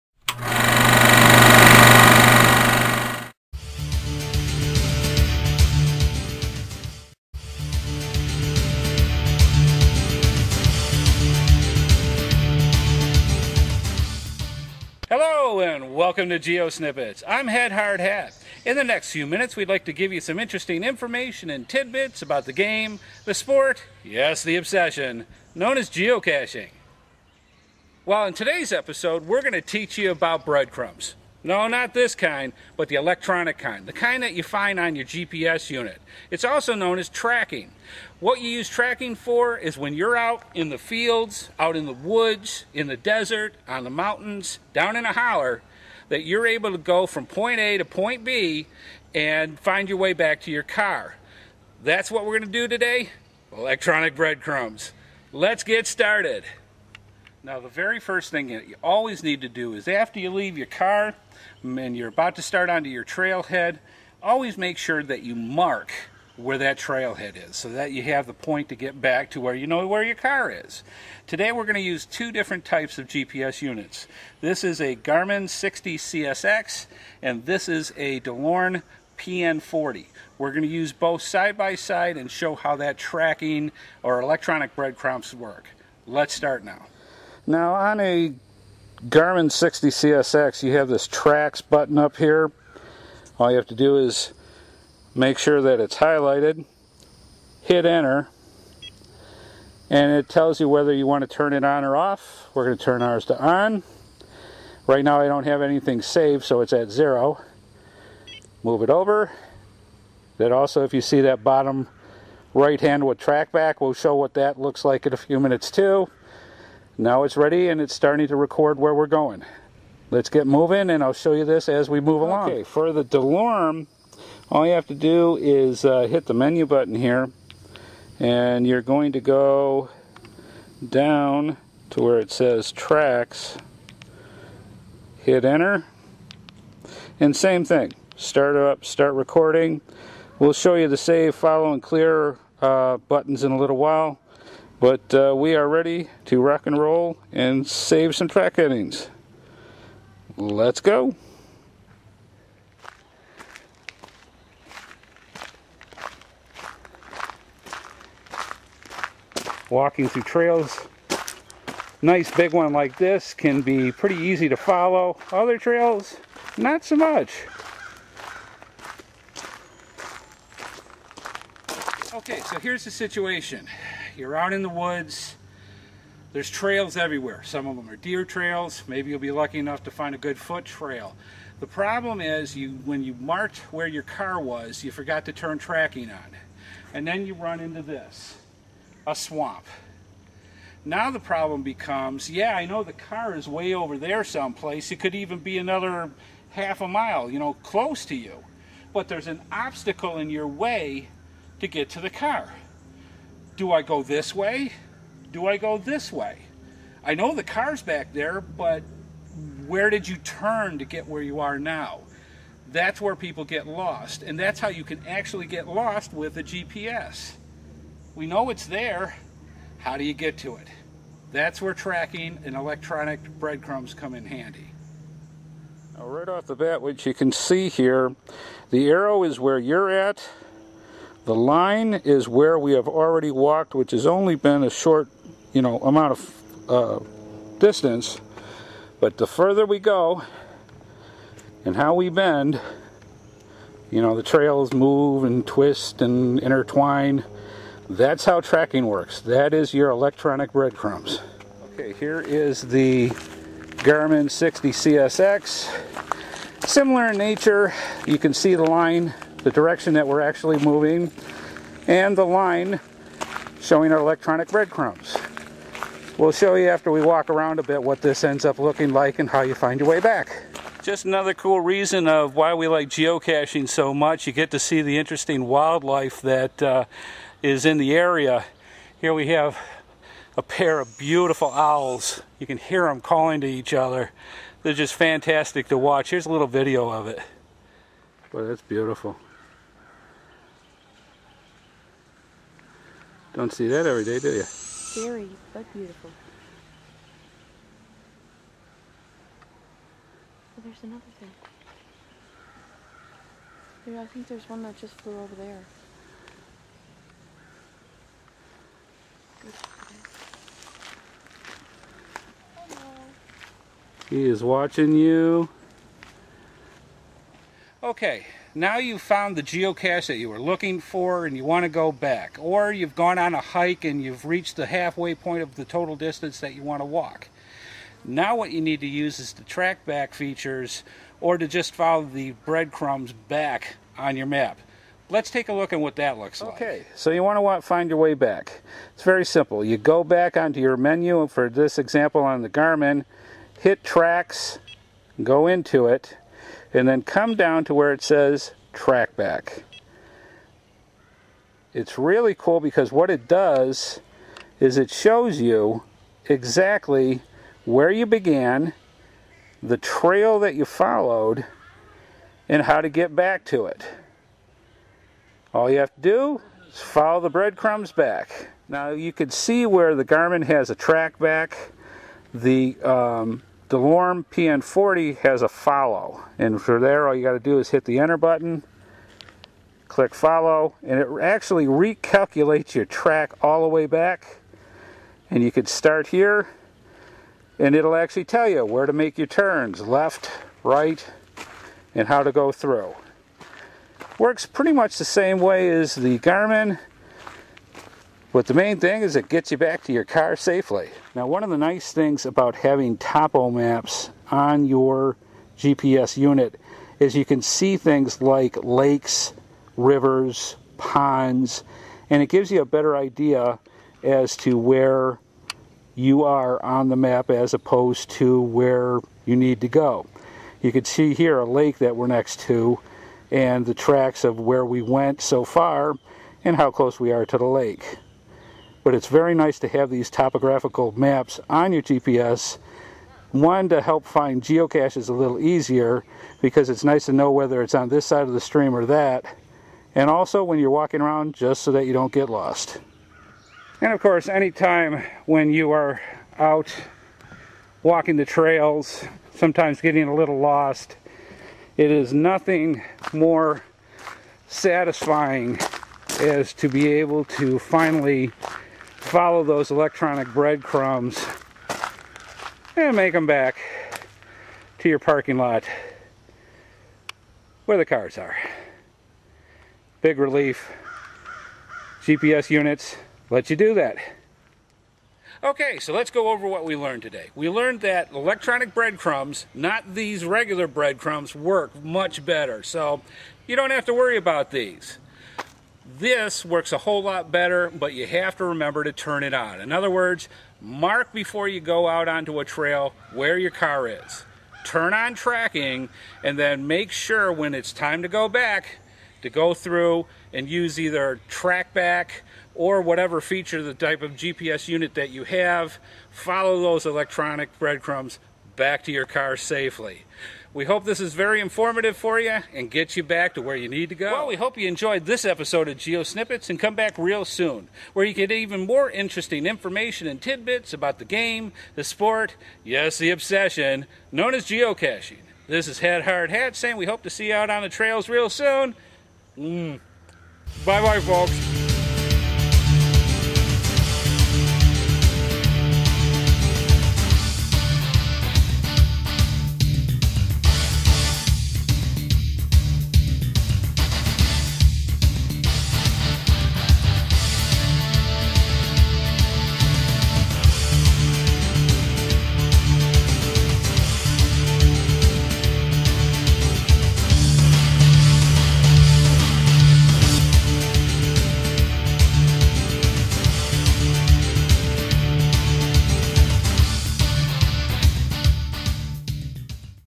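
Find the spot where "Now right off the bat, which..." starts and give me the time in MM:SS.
03:45.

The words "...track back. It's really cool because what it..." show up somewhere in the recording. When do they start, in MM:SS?
05:48.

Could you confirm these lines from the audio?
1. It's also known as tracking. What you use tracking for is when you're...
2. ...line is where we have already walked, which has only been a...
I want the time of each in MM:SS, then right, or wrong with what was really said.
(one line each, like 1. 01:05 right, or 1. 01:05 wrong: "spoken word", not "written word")
1. 00:36 right
2. 03:51 right.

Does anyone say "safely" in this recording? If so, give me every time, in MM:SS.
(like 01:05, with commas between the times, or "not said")
06:40, 08:29.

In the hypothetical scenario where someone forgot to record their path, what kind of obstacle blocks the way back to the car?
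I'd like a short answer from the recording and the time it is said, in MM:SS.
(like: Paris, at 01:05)
a swamp, at 03:09.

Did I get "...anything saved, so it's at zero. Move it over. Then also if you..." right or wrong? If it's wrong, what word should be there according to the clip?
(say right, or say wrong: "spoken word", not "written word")
right.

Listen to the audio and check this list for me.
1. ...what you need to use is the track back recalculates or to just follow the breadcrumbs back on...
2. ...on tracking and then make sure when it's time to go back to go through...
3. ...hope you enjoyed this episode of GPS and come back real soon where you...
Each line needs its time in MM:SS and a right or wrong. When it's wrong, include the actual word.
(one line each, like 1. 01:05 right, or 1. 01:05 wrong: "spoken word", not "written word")
1. 05:28 wrong: "features", not "recalculates"
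2. 08:14 right
3. 08:34 wrong: "GeoSnippits", not "GPS".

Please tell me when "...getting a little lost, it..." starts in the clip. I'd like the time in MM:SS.
07:29.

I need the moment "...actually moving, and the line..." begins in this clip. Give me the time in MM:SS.
04:20.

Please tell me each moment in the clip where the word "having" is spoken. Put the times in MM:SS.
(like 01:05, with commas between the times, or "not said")
06:42.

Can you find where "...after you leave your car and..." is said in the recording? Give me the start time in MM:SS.
00:59.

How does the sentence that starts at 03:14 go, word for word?
It could even be another half a mile, you know, close to you.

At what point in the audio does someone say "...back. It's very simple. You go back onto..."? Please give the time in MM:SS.
05:38.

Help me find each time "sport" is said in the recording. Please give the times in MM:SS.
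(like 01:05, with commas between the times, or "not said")
00:23, 08:41.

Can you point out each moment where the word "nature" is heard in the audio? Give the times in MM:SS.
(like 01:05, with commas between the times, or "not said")
04:17.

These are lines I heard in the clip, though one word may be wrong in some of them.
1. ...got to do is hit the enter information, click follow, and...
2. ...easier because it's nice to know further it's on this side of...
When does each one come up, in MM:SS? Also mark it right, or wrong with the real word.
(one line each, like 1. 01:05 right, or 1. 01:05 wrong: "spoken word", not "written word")
1. 06:17 wrong: "button", not "information"
2. 07:15 wrong: "whether", not "further".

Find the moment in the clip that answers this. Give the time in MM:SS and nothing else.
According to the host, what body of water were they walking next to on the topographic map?
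07:01.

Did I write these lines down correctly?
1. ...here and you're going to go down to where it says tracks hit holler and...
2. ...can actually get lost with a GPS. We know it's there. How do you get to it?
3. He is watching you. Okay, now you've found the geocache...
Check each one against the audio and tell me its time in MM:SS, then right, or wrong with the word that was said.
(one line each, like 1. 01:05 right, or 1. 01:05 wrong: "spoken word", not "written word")
1. 02:06 wrong: "enter", not "holler"
2. 03:34 right
3. 05:14 right.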